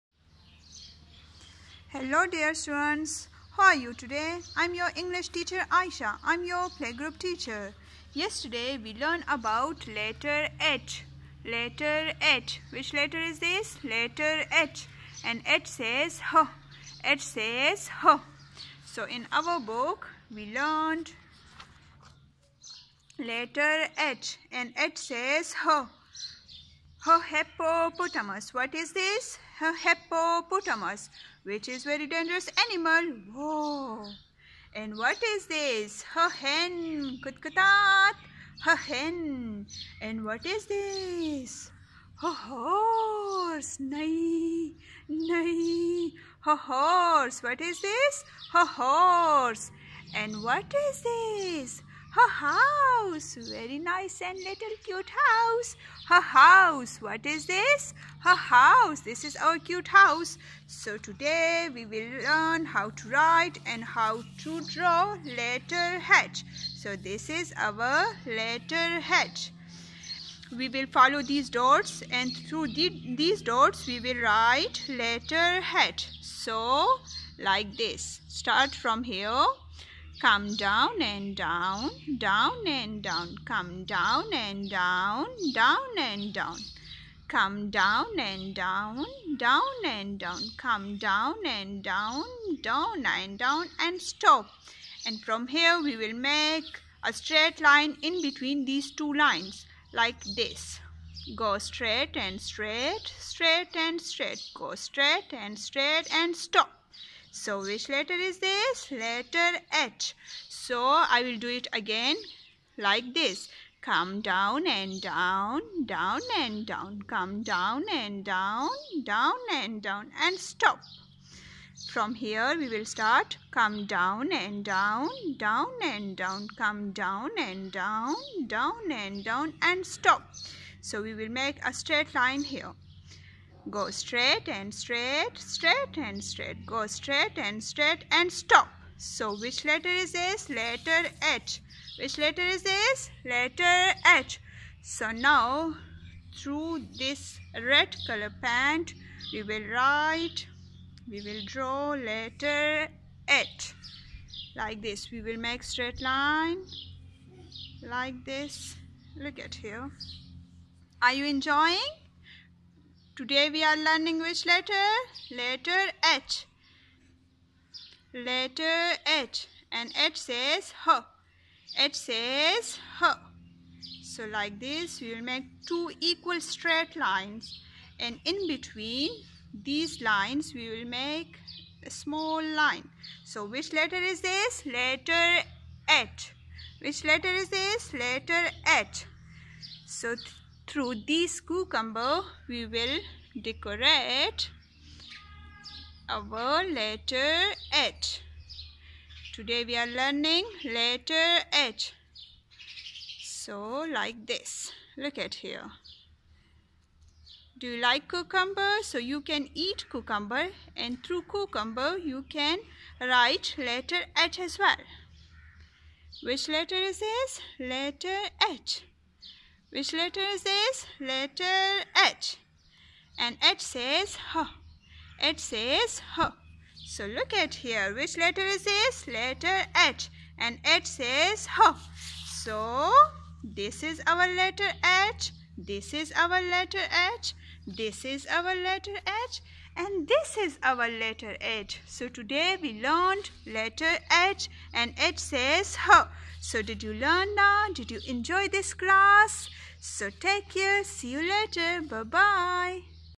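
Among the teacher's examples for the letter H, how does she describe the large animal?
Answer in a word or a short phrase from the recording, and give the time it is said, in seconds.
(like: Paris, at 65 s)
dangerous, at 32 s.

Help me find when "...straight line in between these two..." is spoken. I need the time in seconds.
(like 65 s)
97 s.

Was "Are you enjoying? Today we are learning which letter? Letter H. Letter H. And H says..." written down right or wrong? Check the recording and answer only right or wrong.
right.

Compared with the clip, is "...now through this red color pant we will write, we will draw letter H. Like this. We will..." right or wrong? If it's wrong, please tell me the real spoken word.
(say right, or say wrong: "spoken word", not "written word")
right.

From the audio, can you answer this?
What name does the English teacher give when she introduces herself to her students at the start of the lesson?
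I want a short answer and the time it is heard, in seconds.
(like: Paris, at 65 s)
Aisha, at 5 s.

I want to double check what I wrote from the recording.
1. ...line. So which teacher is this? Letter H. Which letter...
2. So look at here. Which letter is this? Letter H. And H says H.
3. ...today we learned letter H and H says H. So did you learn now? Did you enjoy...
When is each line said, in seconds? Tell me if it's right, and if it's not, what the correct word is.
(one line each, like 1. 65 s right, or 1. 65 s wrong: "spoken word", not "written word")
1. 182 s wrong: "letter", not "teacher"
2. 226 s right
3. 242 s right.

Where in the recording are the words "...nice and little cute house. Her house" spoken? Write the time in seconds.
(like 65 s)
53 s.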